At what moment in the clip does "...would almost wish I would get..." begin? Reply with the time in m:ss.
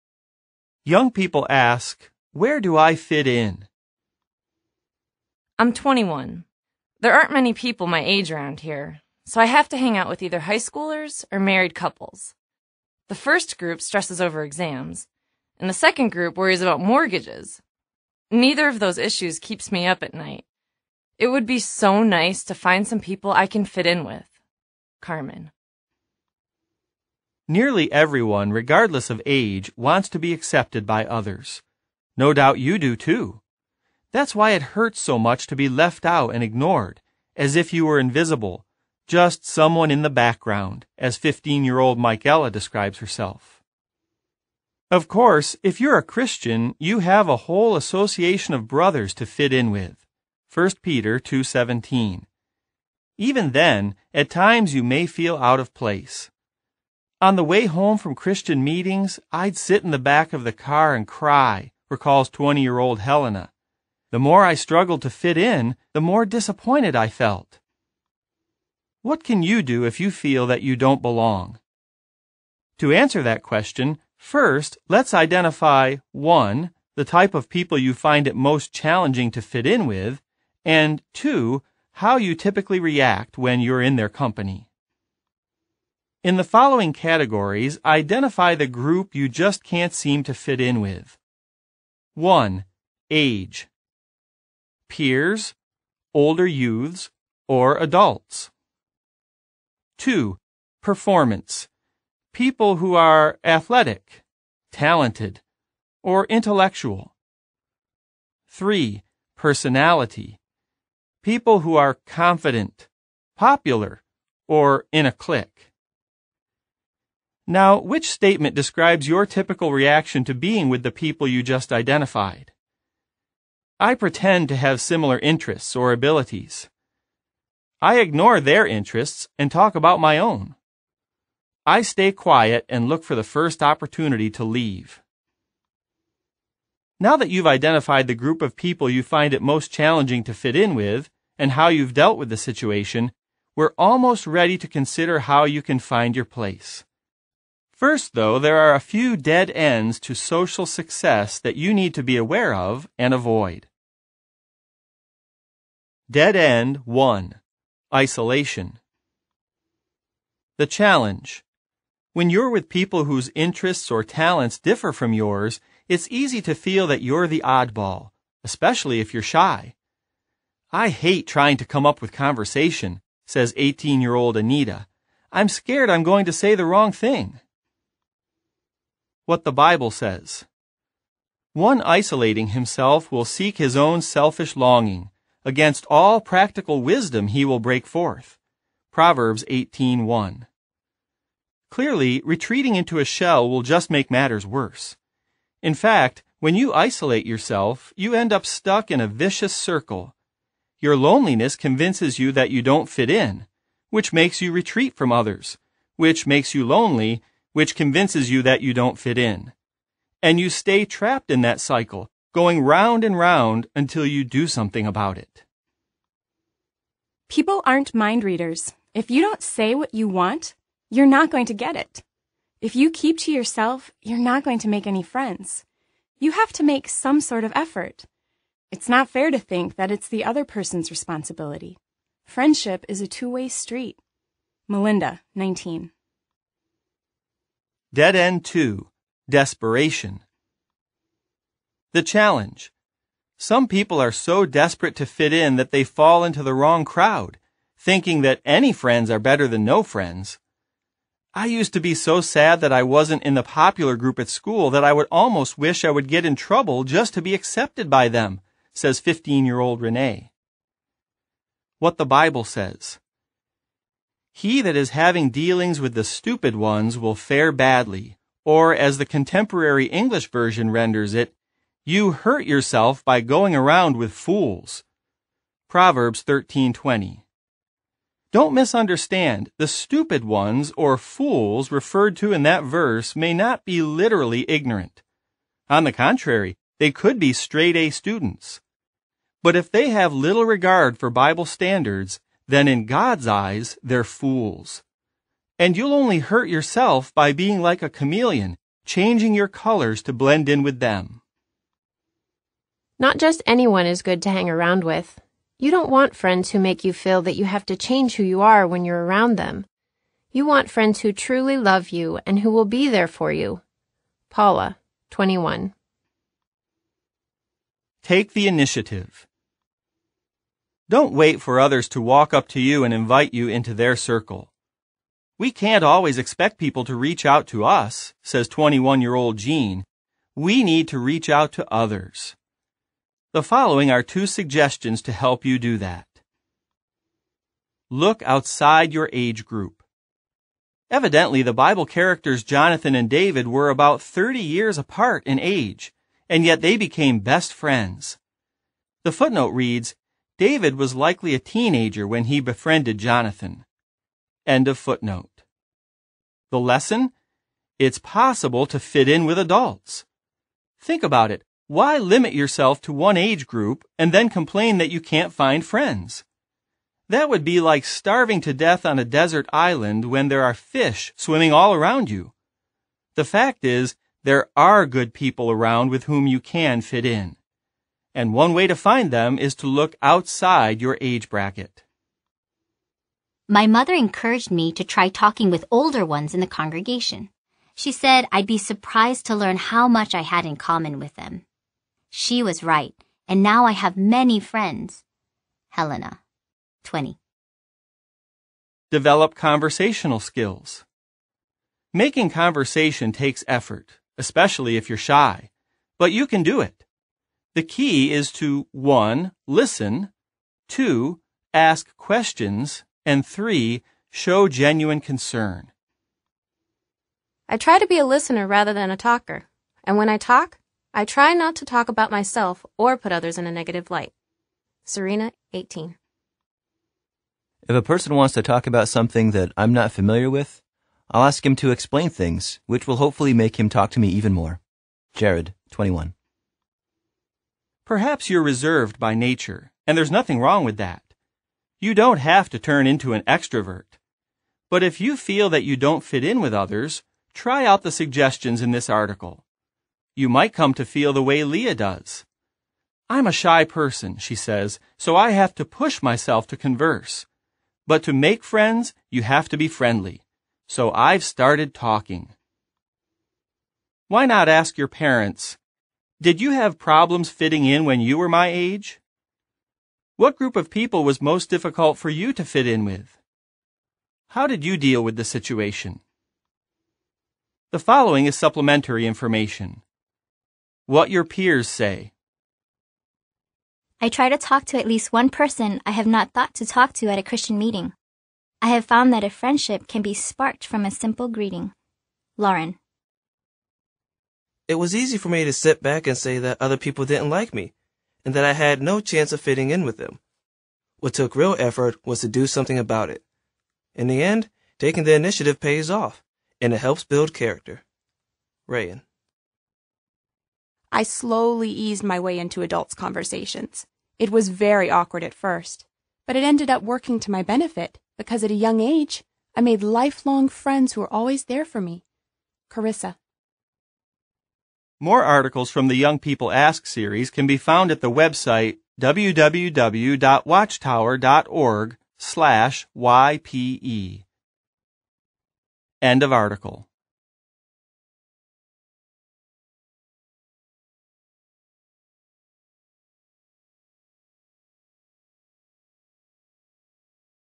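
4:14.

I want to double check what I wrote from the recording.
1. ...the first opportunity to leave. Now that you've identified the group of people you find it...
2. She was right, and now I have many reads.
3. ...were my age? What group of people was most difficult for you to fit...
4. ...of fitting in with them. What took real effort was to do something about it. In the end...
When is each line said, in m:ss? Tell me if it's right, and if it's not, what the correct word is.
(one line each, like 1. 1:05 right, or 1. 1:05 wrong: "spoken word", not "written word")
1. 2:13 right
2. 6:32 wrong: "friends", not "reads"
3. 7:48 right
4. 8:19 right.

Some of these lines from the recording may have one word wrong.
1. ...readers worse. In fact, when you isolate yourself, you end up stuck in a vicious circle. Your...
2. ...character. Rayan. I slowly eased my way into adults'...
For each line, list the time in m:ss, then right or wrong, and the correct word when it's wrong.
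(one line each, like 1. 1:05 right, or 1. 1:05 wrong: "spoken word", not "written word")
1. 3:14 wrong: "matters", not "readers"
2. 8:27 right.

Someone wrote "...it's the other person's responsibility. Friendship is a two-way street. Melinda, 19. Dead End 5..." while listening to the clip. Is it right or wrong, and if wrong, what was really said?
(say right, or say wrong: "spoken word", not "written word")
wrong: "2", not "5".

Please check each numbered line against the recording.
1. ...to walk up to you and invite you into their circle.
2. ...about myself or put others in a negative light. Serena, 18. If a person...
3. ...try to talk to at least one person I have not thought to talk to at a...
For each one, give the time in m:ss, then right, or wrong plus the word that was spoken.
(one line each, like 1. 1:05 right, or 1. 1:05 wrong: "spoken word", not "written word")
1. 5:21 right
2. 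7:01 right
3. 8:04 right.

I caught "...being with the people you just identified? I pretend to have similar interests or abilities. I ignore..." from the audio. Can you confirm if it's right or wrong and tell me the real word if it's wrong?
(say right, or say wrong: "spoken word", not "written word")
right.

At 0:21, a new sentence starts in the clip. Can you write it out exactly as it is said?
It would be so nice to find some people I can fit in with.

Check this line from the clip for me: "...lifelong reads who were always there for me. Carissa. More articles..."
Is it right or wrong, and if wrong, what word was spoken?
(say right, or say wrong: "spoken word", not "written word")
wrong: "friends", not "reads".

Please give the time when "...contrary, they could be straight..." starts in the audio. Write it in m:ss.
4:45.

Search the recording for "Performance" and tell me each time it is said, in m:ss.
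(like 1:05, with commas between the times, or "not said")
1:40.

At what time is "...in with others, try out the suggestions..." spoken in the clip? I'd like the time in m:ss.
7:26.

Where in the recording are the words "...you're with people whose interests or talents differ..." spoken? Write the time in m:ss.
2:42.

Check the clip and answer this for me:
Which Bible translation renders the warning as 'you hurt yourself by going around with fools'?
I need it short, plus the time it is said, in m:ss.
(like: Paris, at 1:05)
Contemporary English Version, at 4:29.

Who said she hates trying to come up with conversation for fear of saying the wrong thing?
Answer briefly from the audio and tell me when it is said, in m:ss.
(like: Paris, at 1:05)
Anita, at 2:54.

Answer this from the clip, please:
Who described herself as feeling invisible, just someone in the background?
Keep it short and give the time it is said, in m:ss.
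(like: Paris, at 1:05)
Michaela, at 0:41.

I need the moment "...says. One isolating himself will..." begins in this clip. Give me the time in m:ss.
2:59.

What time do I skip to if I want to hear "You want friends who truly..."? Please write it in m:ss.
5:10.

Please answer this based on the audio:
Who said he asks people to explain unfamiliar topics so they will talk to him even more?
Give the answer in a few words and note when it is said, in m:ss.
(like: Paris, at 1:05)
Jared, at 7:15.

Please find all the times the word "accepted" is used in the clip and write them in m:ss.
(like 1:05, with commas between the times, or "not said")
0:30, 4:17.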